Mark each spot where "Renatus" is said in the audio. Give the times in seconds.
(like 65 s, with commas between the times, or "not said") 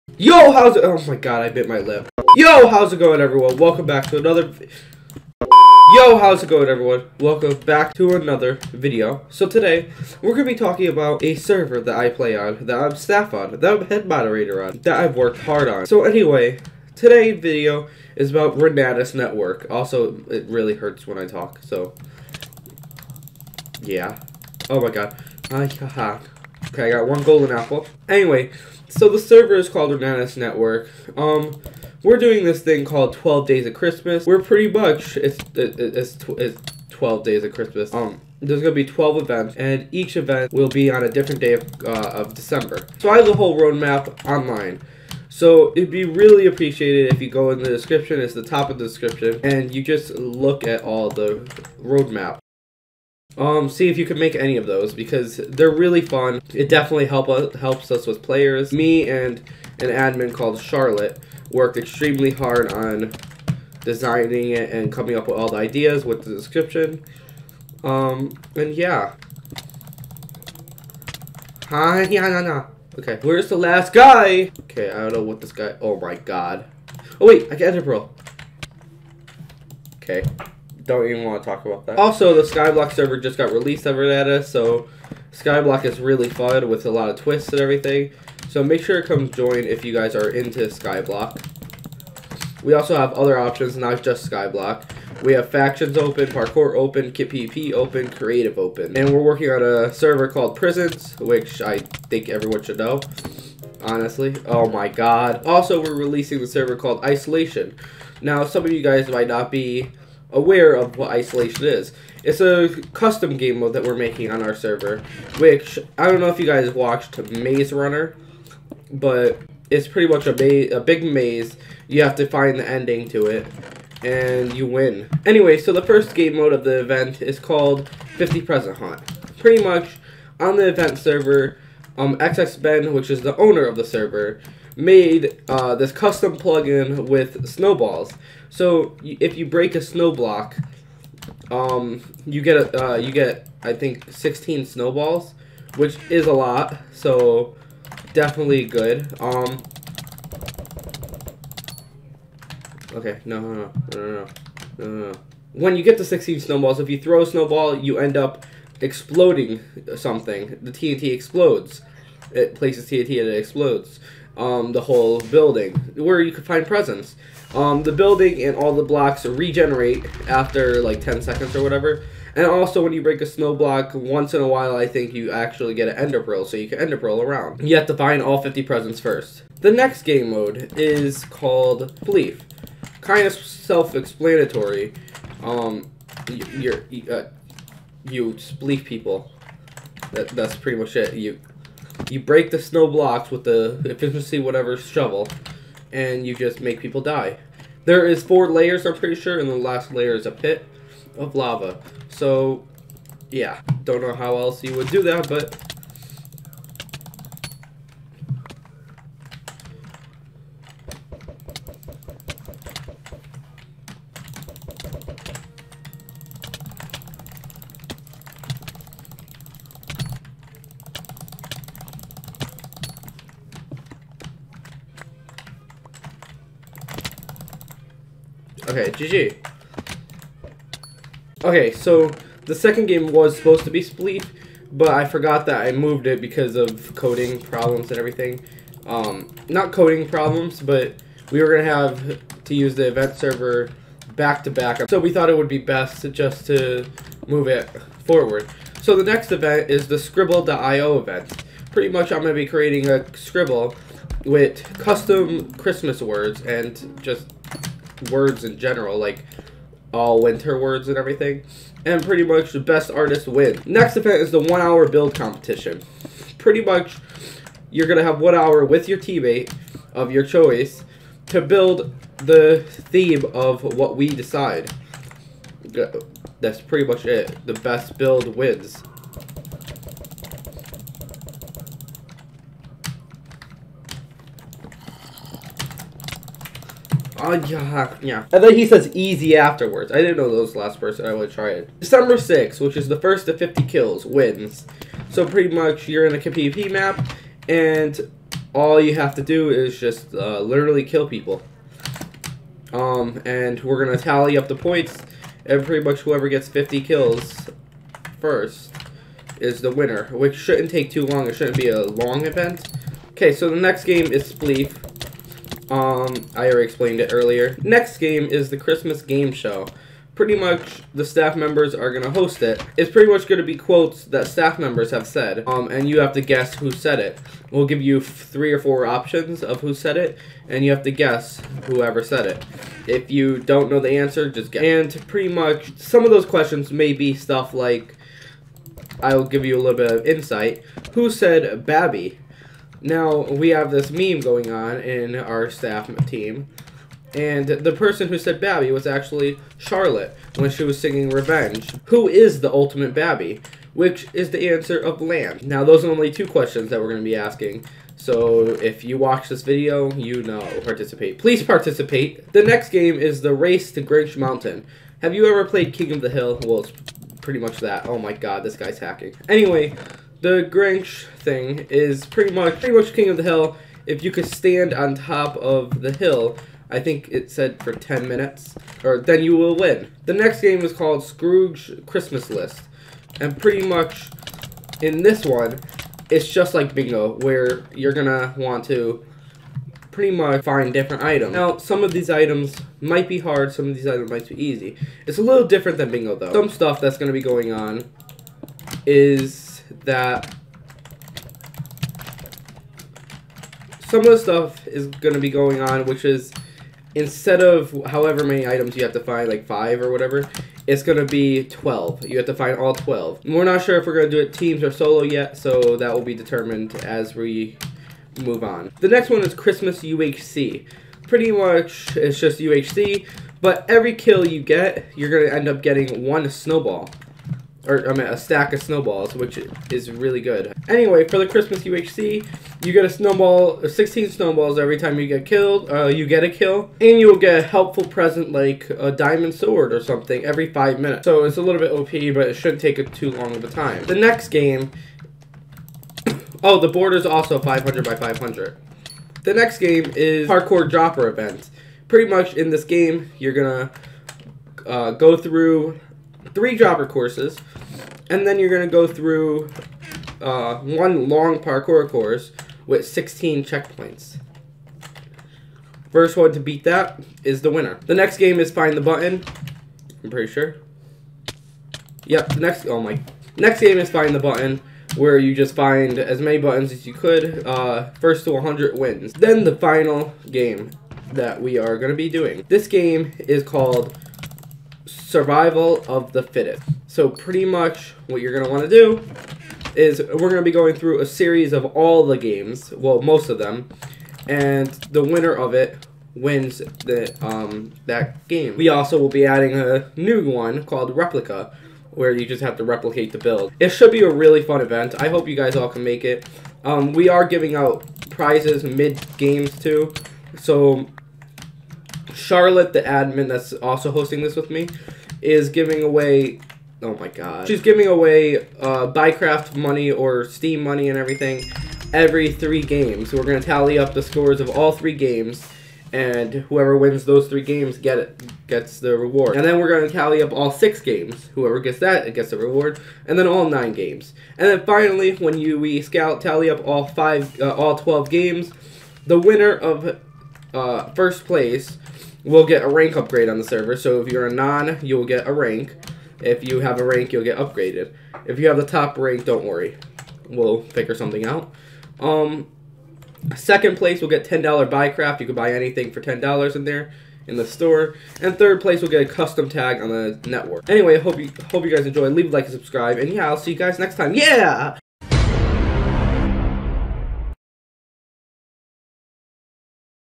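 18 s, 29 s.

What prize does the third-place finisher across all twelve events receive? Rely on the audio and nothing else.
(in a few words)
custom tag.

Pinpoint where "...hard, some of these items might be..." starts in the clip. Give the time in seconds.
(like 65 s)
393 s.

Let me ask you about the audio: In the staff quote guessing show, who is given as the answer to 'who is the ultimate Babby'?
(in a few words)
Lamb.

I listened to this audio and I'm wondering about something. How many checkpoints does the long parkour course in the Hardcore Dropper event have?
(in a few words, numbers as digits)
16.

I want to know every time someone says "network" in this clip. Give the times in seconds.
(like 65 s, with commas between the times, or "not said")
19 s, 30 s, 560 s.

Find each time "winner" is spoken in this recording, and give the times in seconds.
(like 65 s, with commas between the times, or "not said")
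309 s, 467 s, 495 s, 539 s.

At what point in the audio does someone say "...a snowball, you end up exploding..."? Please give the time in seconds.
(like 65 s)
157 s.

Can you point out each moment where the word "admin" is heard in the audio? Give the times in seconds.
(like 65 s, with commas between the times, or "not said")
59 s, 512 s.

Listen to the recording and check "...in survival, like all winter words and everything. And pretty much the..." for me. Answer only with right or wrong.
wrong.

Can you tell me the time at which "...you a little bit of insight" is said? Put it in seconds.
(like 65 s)
339 s.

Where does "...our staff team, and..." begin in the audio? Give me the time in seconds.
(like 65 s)
345 s.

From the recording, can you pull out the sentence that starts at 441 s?
So it's a little bit OP, but it shouldn't take too long of a time.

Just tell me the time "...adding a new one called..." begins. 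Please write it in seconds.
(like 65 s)
499 s.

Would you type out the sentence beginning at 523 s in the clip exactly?
So we're gonna tally up the scores of all three games, and whoever wins those three games get it, gets the reward.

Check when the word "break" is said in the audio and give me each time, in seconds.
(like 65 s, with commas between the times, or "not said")
139 s, 173 s, 192 s.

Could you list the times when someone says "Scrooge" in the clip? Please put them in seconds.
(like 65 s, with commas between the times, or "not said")
381 s.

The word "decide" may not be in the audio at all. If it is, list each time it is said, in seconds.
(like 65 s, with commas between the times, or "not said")
274 s.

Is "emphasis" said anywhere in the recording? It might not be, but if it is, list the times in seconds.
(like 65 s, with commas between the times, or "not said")
not said.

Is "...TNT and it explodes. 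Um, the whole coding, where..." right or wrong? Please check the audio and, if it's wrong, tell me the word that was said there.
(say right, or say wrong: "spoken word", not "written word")
wrong: "building", not "coding".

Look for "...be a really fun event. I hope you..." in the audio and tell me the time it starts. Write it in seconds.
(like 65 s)
503 s.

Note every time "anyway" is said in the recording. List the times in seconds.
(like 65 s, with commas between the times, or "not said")
16 s, 28 s, 125 s, 369 s, 430 s, 560 s.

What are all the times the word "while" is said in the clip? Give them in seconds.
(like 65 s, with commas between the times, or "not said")
174 s.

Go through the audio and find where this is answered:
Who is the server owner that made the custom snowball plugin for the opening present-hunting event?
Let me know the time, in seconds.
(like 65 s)
132 s.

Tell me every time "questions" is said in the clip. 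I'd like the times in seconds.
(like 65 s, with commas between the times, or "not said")
336 s, 356 s.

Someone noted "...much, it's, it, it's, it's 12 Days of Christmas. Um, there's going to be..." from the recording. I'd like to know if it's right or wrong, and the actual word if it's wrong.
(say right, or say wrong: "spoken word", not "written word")
right.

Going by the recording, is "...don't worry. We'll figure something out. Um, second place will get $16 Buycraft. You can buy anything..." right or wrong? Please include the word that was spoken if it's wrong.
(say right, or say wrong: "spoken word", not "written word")
wrong: "10", not "16".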